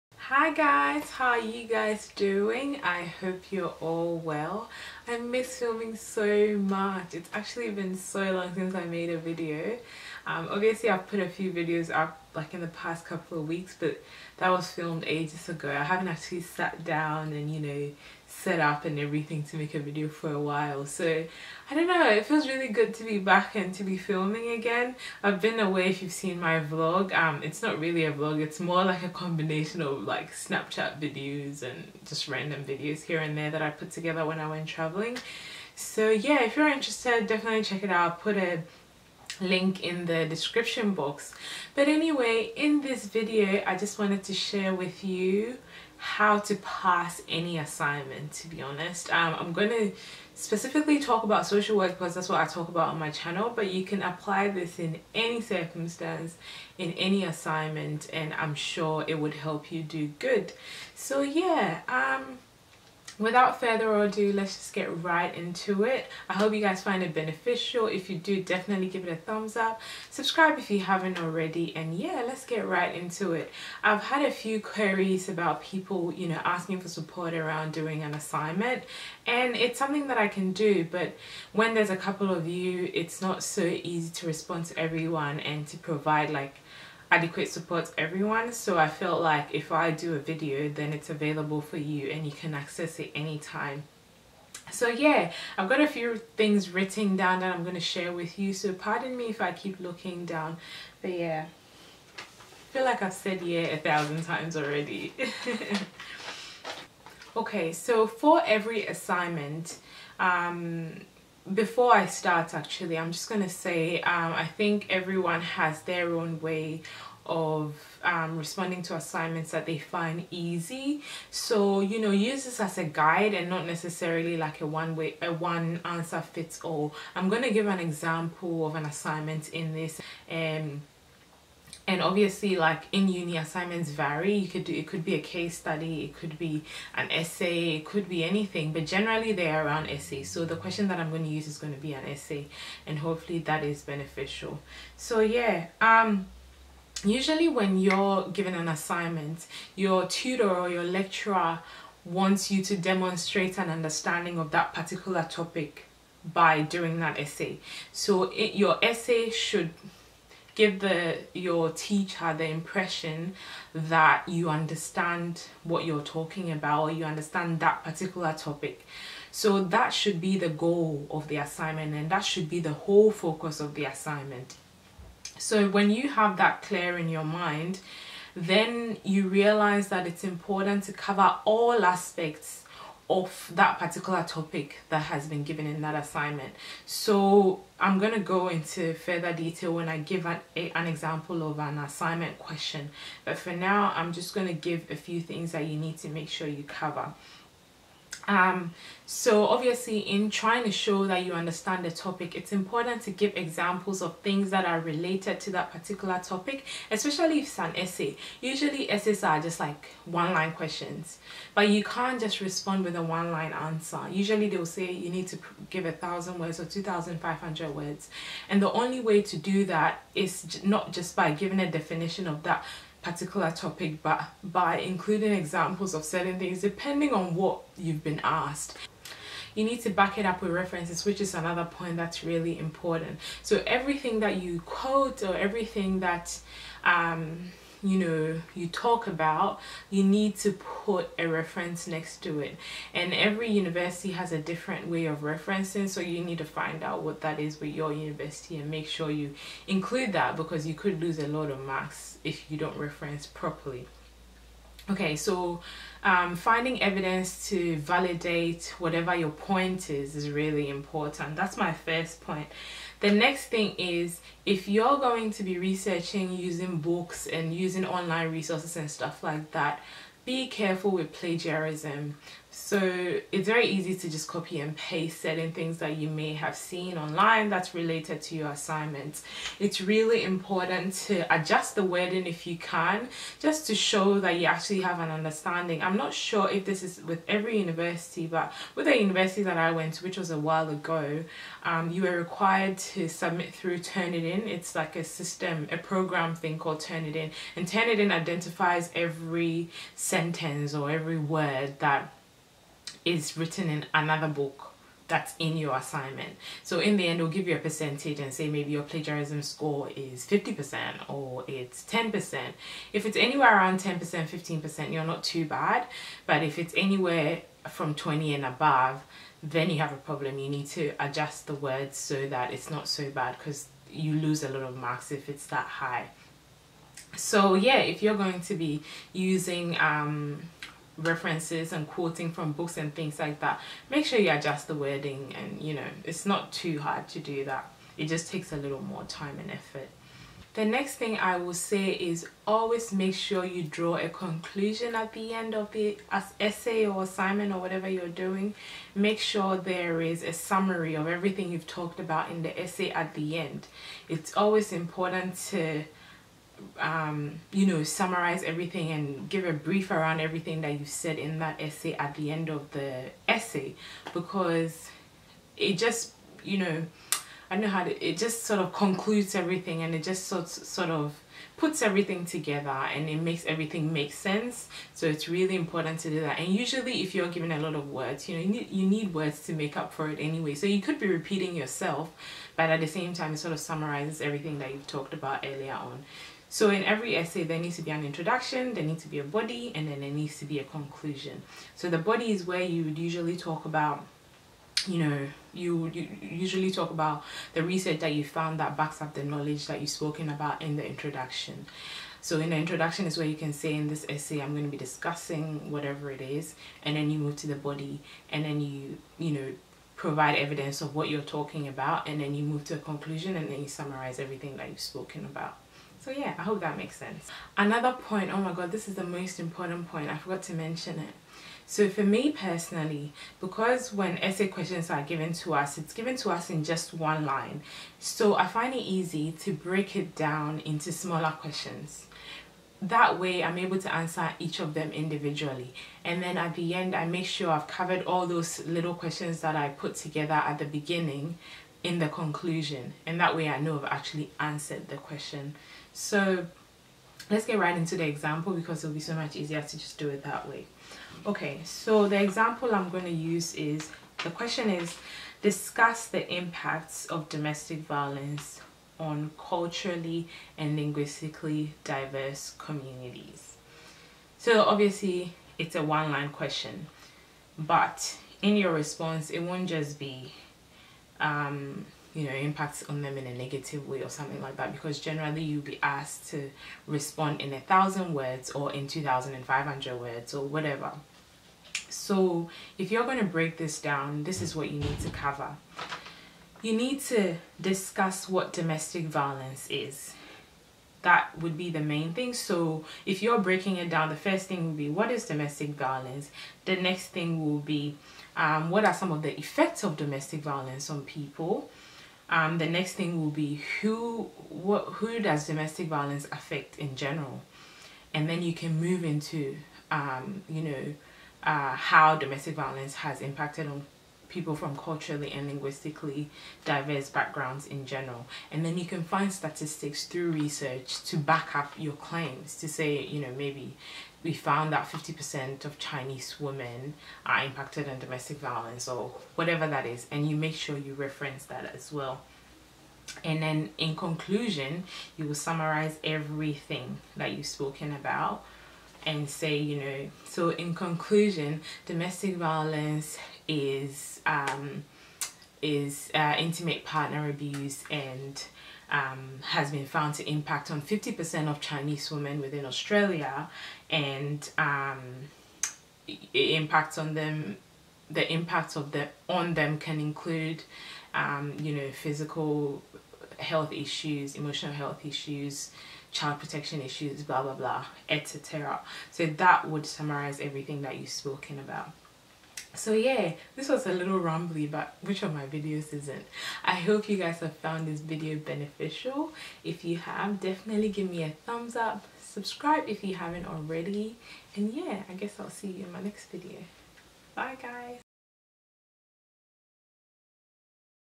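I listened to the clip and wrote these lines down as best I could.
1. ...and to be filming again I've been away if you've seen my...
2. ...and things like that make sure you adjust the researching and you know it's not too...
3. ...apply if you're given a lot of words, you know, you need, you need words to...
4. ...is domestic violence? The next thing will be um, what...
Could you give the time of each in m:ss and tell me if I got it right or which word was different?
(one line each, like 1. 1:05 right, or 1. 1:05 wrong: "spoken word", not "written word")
1. 0:23 right
2. 5:32 wrong: "wording", not "researching"
3. 6:16 wrong: "usually", not "apply"
4. 8:15 right.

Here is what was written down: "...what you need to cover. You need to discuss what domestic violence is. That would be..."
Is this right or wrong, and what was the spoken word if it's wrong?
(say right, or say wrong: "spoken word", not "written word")
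right.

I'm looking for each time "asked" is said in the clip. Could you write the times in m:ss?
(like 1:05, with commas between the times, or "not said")
3:48, 7:55.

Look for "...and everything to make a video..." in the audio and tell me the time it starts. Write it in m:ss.
0:18.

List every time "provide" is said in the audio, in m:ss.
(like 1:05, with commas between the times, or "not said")
1:25, 6:49.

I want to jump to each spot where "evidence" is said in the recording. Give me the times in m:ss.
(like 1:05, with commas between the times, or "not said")
4:16, 6:50.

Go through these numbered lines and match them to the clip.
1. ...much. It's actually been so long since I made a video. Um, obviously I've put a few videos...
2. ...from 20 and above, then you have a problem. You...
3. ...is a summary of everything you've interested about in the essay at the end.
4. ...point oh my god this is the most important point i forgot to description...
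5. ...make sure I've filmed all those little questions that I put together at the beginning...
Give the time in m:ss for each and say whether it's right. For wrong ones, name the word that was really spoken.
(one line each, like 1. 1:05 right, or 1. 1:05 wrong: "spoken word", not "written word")
1. 0:06 right
2. 5:17 right
3. 5:50 wrong: "talked", not "interested"
4. 6:57 wrong: "mention", not "description"
5. 7:17 wrong: "covered", not "filmed".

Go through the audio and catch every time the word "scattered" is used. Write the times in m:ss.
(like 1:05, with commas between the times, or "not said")
not said.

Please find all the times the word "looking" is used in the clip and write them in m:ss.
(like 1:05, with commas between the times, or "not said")
1:39.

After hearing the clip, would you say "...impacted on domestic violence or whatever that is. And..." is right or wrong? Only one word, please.
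right.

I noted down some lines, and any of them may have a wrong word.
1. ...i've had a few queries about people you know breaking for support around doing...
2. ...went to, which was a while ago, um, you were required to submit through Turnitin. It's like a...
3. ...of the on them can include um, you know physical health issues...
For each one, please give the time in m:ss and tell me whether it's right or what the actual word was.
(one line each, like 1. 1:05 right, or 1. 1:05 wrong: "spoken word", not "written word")
1. 1:13 wrong: "asking", not "breaking"
2. 4:49 right
3. 9:18 right.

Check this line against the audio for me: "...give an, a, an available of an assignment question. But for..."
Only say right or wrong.
wrong.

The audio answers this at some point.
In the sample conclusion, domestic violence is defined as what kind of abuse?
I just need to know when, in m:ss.
9:06.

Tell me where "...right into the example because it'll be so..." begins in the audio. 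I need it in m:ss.
7:27.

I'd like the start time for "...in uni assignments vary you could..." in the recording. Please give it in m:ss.
2:12.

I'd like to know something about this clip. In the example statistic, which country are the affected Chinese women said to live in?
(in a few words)
Australia.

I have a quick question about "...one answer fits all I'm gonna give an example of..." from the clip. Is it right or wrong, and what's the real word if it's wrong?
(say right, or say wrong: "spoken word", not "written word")
right.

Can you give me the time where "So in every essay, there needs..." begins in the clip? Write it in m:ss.
6:26.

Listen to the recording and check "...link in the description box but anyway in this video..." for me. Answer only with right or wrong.
right.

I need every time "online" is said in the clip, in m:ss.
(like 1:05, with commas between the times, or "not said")
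4:27, 4:36.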